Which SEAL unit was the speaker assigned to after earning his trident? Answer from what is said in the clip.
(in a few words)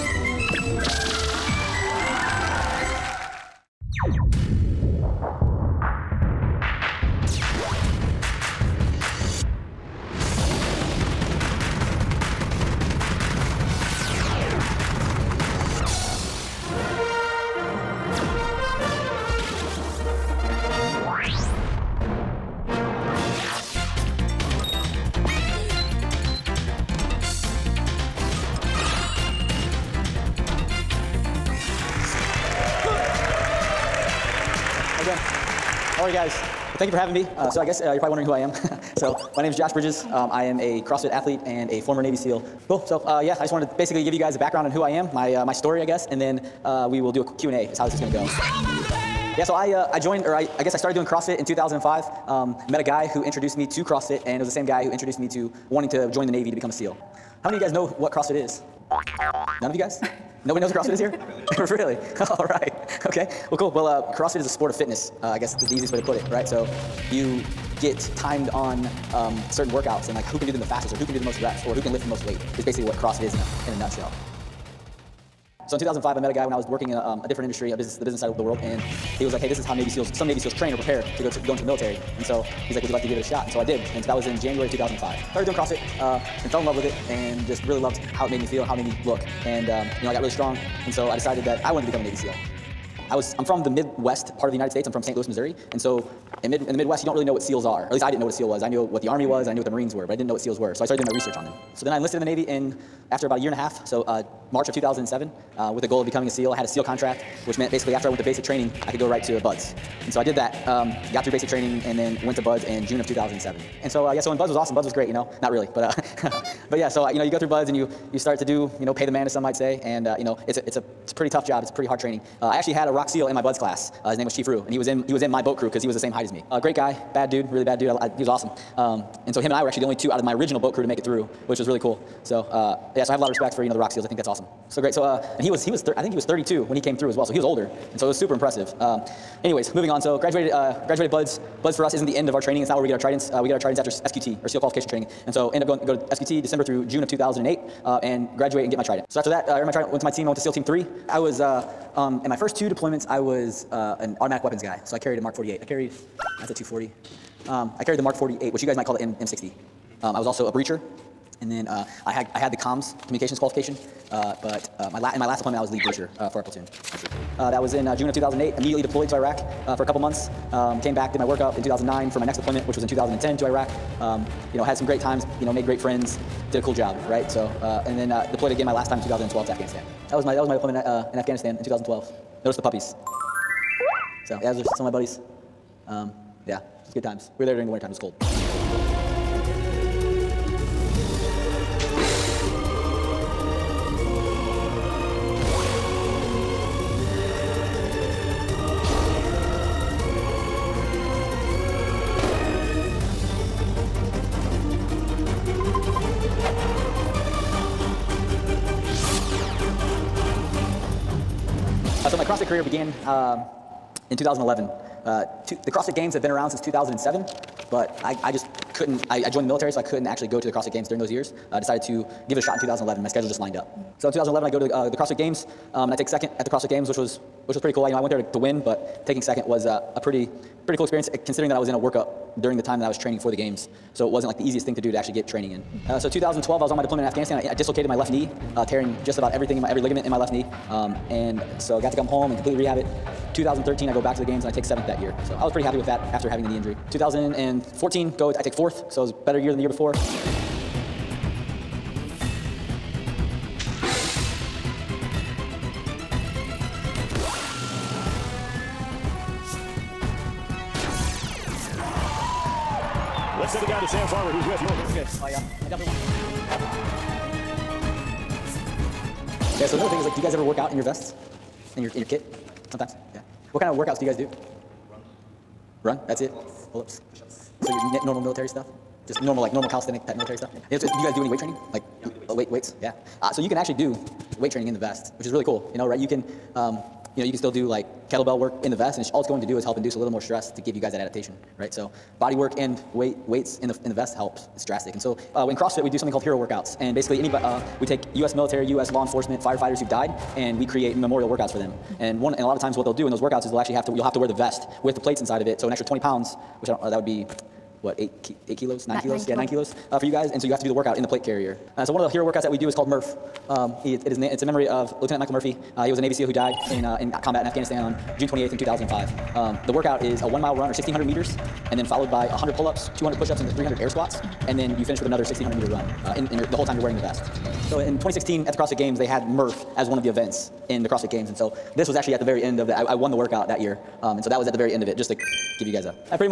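SEAL Team Three.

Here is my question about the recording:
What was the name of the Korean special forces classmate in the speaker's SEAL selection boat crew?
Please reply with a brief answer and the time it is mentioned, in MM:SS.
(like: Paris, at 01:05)
Chief Rue, at 02:04.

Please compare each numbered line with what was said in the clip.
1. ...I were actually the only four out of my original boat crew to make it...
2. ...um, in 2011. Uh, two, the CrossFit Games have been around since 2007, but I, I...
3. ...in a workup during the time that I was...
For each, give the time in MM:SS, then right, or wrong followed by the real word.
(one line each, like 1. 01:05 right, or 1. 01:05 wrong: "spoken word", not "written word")
1. 02:09 wrong: "two", not "four"
2. 03:33 right
3. 03:51 right.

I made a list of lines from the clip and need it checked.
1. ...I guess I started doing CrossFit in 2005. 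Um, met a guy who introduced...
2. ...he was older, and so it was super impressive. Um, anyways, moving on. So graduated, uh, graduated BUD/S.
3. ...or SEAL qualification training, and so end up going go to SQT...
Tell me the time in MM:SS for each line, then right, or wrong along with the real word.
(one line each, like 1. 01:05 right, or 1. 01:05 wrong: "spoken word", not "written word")
1. 00:50 right
2. 02:17 right
3. 02:24 right.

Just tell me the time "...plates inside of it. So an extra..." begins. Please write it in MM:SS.
05:04.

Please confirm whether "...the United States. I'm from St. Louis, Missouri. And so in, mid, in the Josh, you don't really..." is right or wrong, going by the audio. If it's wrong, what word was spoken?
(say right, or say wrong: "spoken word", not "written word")
wrong: "Midwest", not "Josh".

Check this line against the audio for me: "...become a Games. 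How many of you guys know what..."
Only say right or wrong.
wrong.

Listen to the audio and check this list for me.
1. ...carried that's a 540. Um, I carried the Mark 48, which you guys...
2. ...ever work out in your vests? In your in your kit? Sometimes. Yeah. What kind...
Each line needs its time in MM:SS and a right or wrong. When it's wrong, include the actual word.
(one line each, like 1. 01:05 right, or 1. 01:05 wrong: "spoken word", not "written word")
1. 02:35 wrong: "240", not "540"
2. 04:30 right.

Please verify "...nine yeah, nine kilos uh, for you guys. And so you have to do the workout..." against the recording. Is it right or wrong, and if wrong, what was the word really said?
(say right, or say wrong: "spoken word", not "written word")
right.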